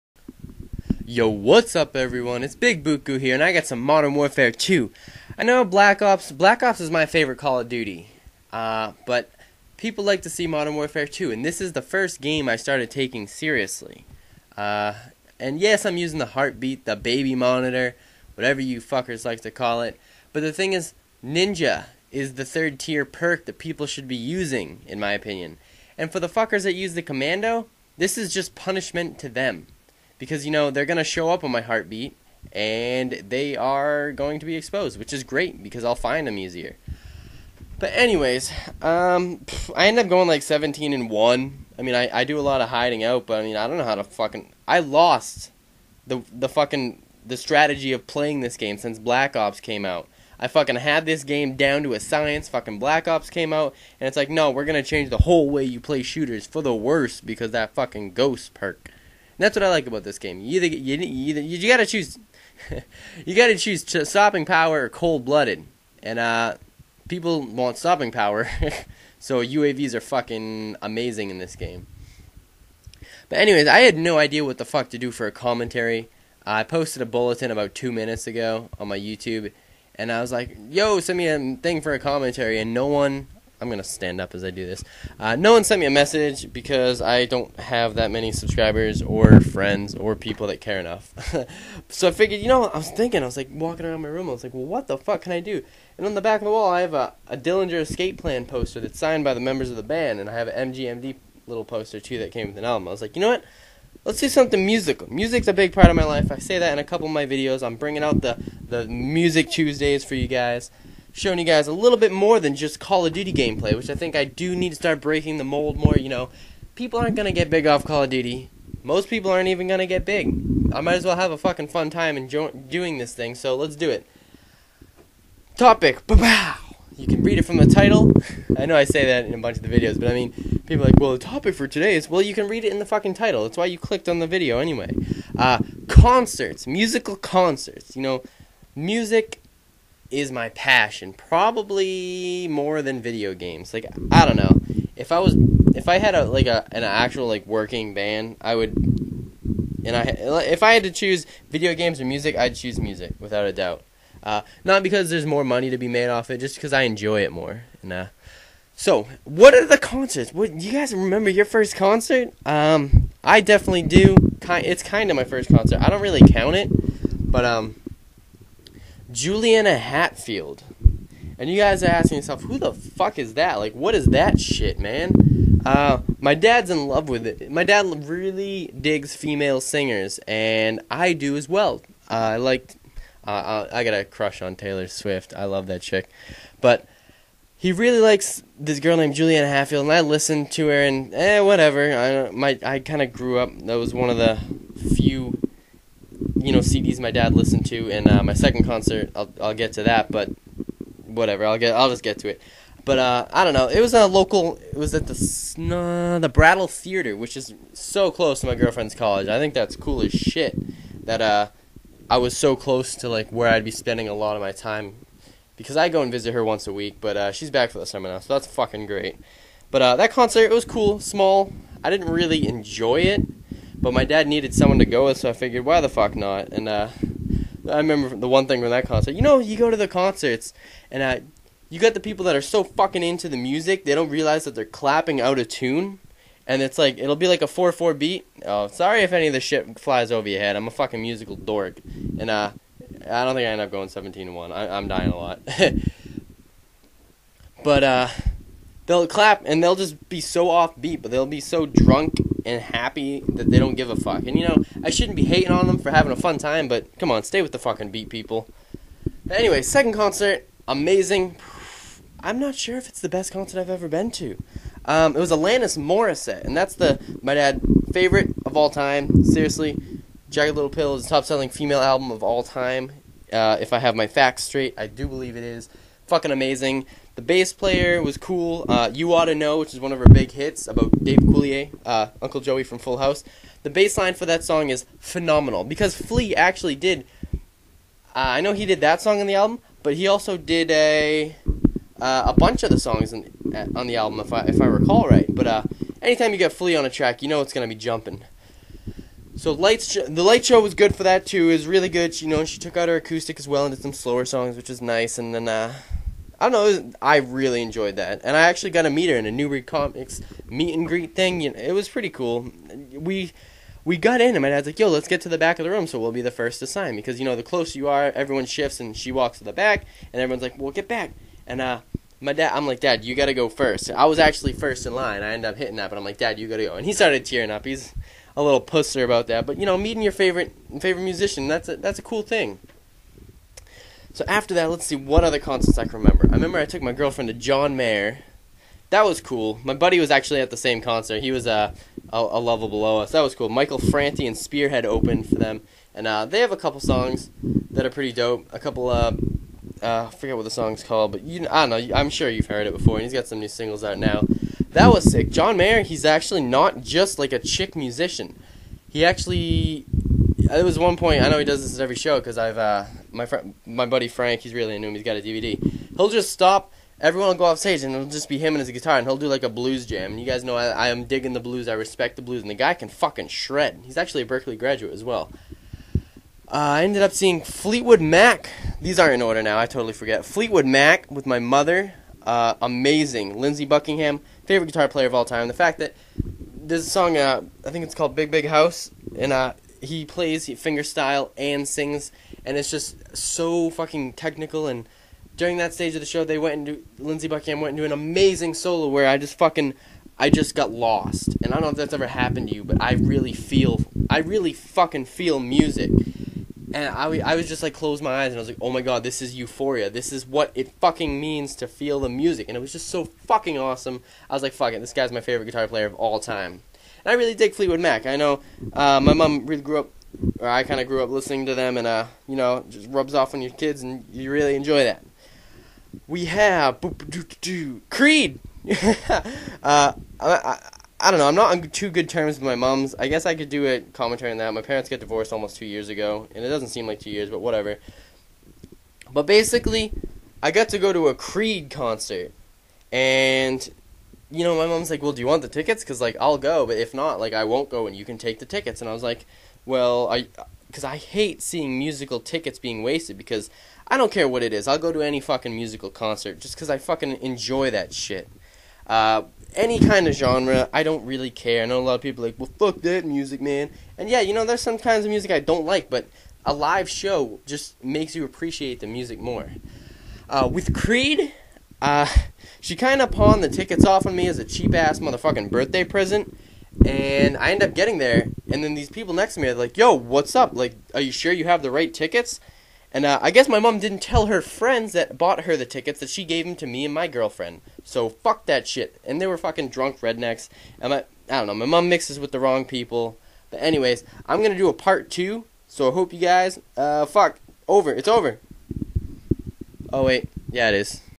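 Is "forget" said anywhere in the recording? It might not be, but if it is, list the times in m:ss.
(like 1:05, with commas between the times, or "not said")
5:50, 6:19.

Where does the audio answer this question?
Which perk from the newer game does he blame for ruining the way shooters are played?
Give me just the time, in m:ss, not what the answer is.
0:58.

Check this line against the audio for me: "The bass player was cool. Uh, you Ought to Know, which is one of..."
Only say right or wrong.
right.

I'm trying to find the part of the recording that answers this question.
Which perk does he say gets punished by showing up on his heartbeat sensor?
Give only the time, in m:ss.
0:27.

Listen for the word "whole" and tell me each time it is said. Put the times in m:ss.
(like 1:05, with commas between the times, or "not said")
0:55.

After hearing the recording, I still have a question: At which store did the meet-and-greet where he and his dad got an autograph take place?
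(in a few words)
Newbury Comics.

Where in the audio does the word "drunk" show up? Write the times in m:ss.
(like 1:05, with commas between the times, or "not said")
4:11, 8:09.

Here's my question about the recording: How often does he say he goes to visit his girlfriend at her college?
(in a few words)
once a week.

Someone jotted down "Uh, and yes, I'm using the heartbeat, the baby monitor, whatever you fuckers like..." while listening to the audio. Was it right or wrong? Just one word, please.
right.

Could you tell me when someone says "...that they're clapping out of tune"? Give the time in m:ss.
3:54.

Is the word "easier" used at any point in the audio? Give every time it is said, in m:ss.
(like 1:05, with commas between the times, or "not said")
0:36.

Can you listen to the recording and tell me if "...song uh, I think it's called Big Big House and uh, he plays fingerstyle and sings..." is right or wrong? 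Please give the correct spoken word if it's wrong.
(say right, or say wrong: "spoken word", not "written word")
right.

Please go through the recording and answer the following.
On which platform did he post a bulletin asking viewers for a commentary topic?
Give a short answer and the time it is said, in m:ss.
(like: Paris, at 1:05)
YouTube, at 1:18.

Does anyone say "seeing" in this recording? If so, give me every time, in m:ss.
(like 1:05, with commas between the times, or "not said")
6:17, 7:31.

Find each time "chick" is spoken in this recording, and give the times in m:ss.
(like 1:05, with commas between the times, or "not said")
3:05, 5:57.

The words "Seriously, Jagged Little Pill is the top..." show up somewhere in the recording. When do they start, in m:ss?
4:29.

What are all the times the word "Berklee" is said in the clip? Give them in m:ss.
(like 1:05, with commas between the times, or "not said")
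6:14.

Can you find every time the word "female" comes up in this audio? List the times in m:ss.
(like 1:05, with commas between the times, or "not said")
2:59, 4:31.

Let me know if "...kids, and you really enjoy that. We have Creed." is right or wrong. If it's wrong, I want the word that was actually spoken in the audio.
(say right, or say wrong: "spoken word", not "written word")
right.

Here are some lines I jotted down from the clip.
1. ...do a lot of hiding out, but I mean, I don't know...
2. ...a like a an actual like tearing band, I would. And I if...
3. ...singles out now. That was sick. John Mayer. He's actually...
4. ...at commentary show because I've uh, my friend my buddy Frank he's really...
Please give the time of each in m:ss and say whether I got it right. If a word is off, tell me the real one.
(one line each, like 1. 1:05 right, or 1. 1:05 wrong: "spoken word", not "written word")
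1. 0:42 right
2. 2:26 wrong: "working", not "tearing"
3. 5:53 right
4. 6:01 wrong: "every", not "commentary".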